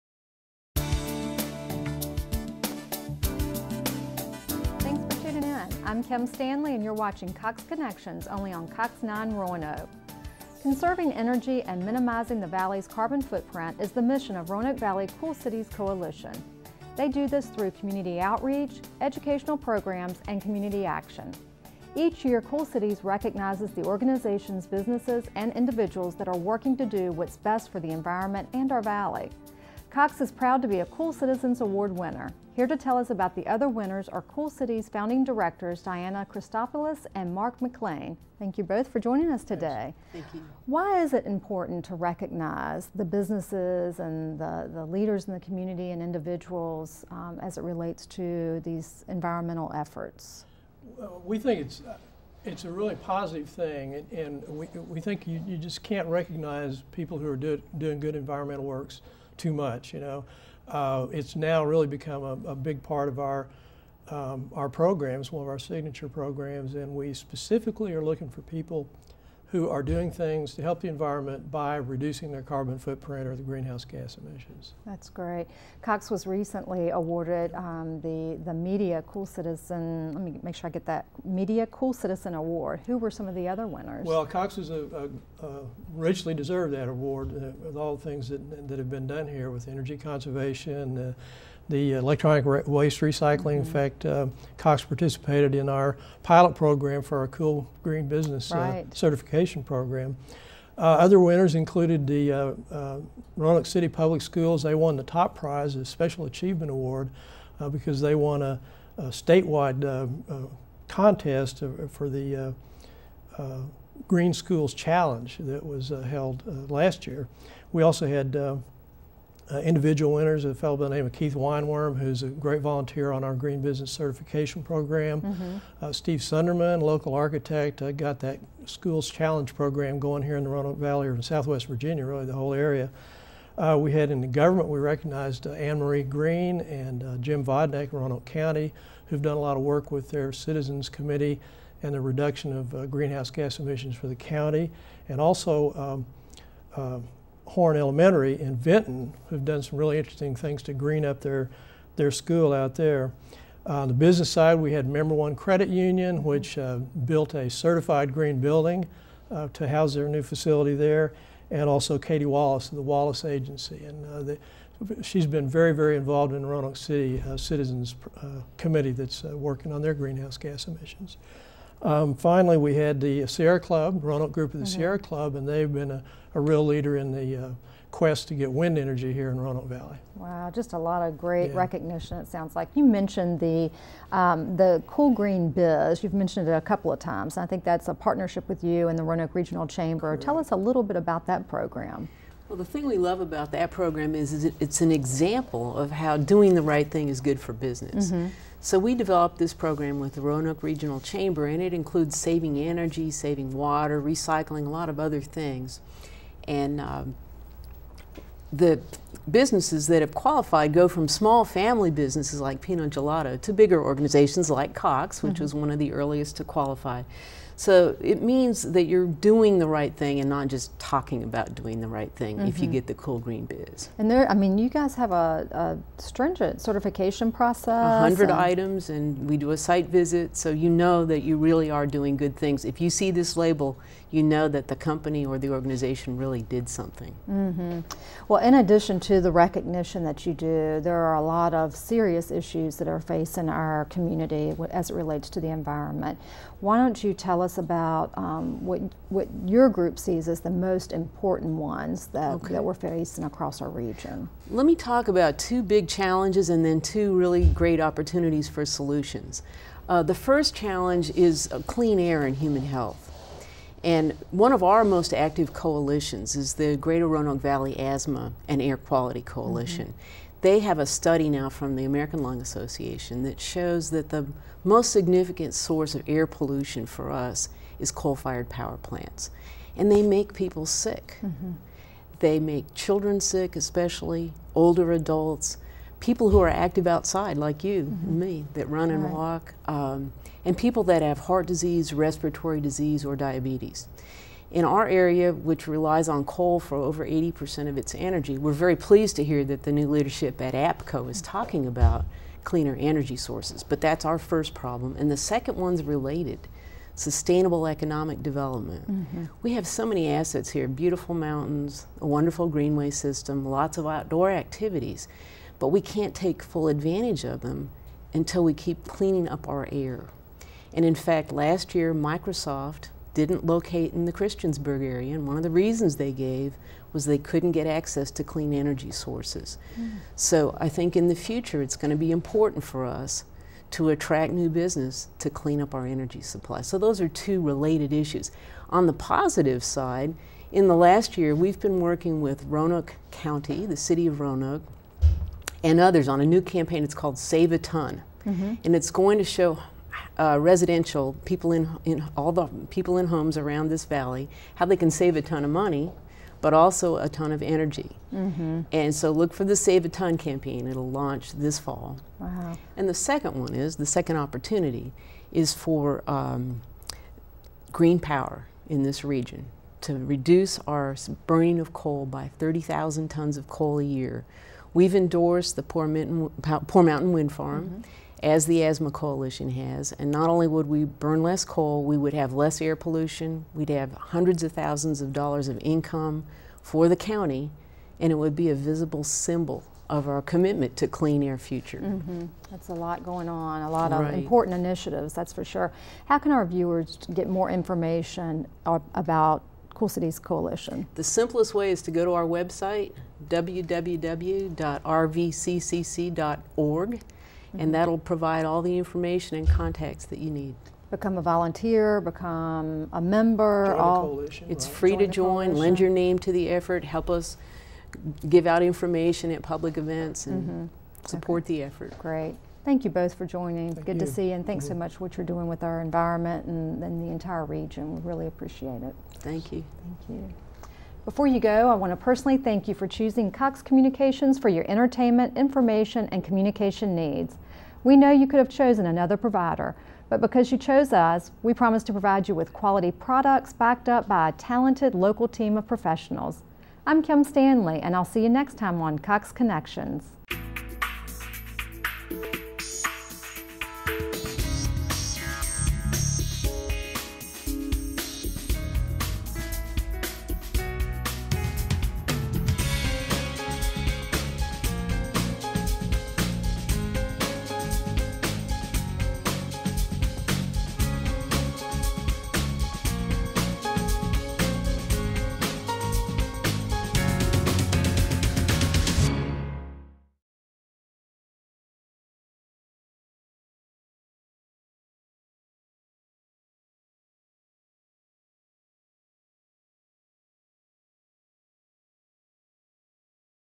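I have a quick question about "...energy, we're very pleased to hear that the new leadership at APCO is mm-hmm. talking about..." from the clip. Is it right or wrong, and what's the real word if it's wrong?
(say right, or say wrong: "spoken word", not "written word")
right.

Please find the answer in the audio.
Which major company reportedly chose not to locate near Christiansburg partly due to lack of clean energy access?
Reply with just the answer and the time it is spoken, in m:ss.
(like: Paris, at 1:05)
Microsoft, at 5:21.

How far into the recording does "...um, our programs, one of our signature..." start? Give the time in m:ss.
1:04.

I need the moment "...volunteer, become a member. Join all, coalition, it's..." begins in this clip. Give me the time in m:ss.
6:51.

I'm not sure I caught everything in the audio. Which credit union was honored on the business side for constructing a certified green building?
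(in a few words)
Member One Credit Union.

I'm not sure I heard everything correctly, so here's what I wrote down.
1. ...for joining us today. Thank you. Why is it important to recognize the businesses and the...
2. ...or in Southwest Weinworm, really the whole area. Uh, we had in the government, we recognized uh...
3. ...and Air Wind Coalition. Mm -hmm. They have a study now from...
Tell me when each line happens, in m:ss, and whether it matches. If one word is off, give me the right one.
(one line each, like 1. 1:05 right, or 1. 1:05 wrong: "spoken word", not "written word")
1. 0:38 right
2. 2:11 wrong: "Virginia", not "Weinworm"
3. 4:28 wrong: "Quality", not "Wind".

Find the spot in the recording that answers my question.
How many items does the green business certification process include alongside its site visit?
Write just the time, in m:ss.
3:48.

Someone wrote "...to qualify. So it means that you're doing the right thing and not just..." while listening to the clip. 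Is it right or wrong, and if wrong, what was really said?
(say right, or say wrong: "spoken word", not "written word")
right.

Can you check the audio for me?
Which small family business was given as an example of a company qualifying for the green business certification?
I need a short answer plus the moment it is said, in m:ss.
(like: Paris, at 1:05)
Pinot Gelato, at 3:32.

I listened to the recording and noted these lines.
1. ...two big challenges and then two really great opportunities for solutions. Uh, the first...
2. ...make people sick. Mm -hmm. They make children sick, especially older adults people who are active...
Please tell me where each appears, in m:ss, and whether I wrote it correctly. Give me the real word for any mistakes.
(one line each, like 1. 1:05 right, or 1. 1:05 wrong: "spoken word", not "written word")
1. 4:15 right
2. 4:40 right.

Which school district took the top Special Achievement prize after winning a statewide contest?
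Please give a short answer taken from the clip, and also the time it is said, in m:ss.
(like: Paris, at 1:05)
Roanoke City Public Schools, at 1:43.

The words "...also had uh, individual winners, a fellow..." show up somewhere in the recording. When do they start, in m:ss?
1:57.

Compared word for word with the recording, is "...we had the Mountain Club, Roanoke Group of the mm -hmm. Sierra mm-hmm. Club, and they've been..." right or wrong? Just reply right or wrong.
wrong.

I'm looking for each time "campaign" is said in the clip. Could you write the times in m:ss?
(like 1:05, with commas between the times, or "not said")
5:46, 6:00.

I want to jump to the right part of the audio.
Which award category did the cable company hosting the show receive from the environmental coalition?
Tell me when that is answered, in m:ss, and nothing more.
1:21.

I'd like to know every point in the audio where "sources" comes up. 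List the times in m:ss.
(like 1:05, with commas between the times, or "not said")
4:35, 5:03, 5:28.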